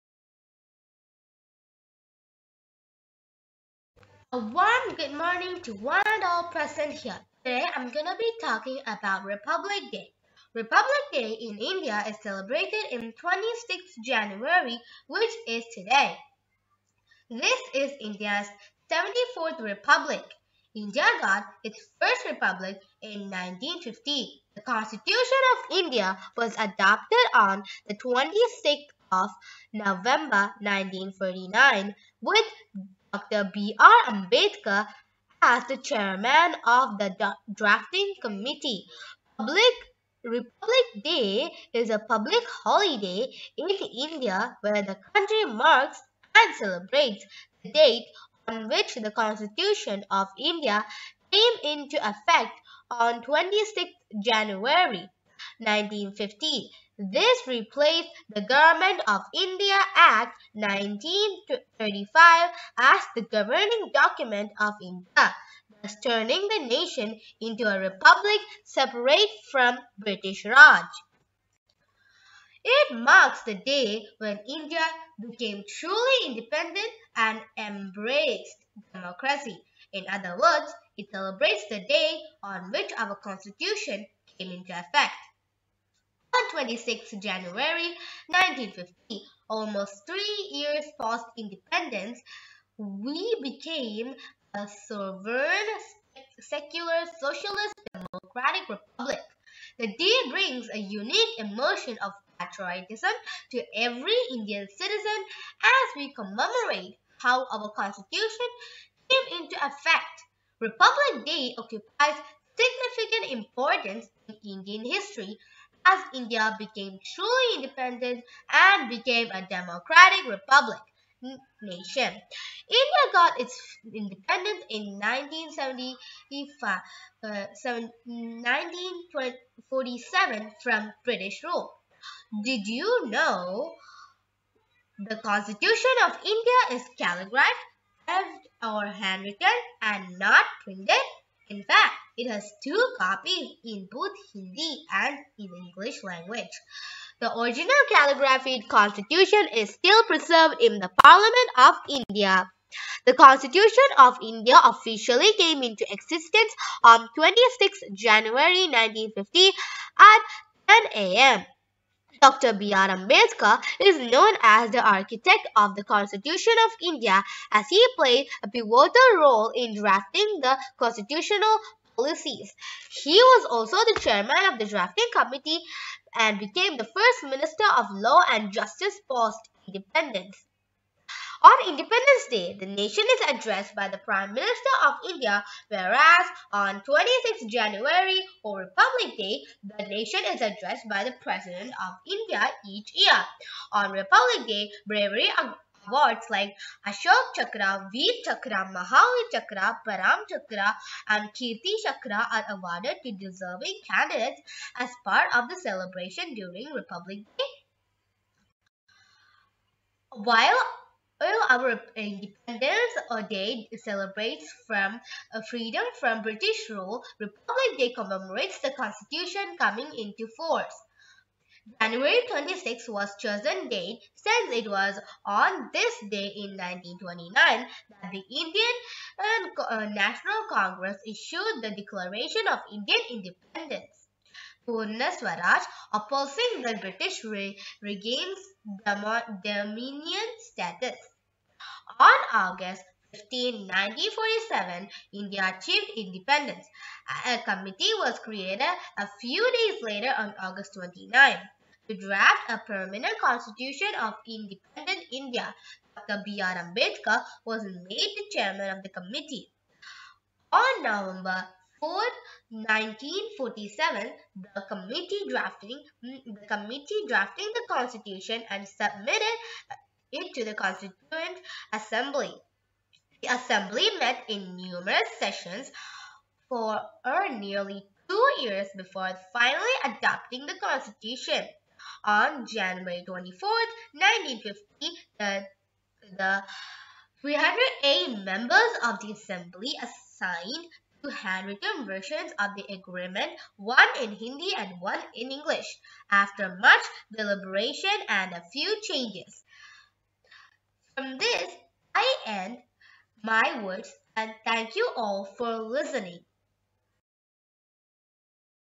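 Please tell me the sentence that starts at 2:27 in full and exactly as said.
The original calligraphied constitution is still preserved in the Parliament of India.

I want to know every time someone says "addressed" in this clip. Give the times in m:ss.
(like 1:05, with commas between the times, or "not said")
3:03, 3:10.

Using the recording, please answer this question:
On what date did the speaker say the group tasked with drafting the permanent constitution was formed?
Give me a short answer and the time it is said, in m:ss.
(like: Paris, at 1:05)
August 29, at 4:10.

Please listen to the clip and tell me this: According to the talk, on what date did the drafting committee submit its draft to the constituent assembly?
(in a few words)
November 4, 1947.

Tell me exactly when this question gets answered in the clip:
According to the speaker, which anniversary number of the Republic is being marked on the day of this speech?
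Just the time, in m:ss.
0:18.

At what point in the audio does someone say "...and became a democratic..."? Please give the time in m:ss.
1:58.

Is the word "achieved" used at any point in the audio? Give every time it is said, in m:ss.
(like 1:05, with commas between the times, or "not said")
4:05.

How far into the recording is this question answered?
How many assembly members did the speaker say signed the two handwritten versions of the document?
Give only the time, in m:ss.
4:47.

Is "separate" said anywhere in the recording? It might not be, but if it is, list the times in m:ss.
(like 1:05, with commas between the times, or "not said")
1:08.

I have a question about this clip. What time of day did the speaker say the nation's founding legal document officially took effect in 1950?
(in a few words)
10 a.m.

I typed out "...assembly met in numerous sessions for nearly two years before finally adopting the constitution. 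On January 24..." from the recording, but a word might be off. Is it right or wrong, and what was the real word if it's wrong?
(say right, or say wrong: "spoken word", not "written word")
right.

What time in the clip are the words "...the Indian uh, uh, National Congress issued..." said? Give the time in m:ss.
3:48.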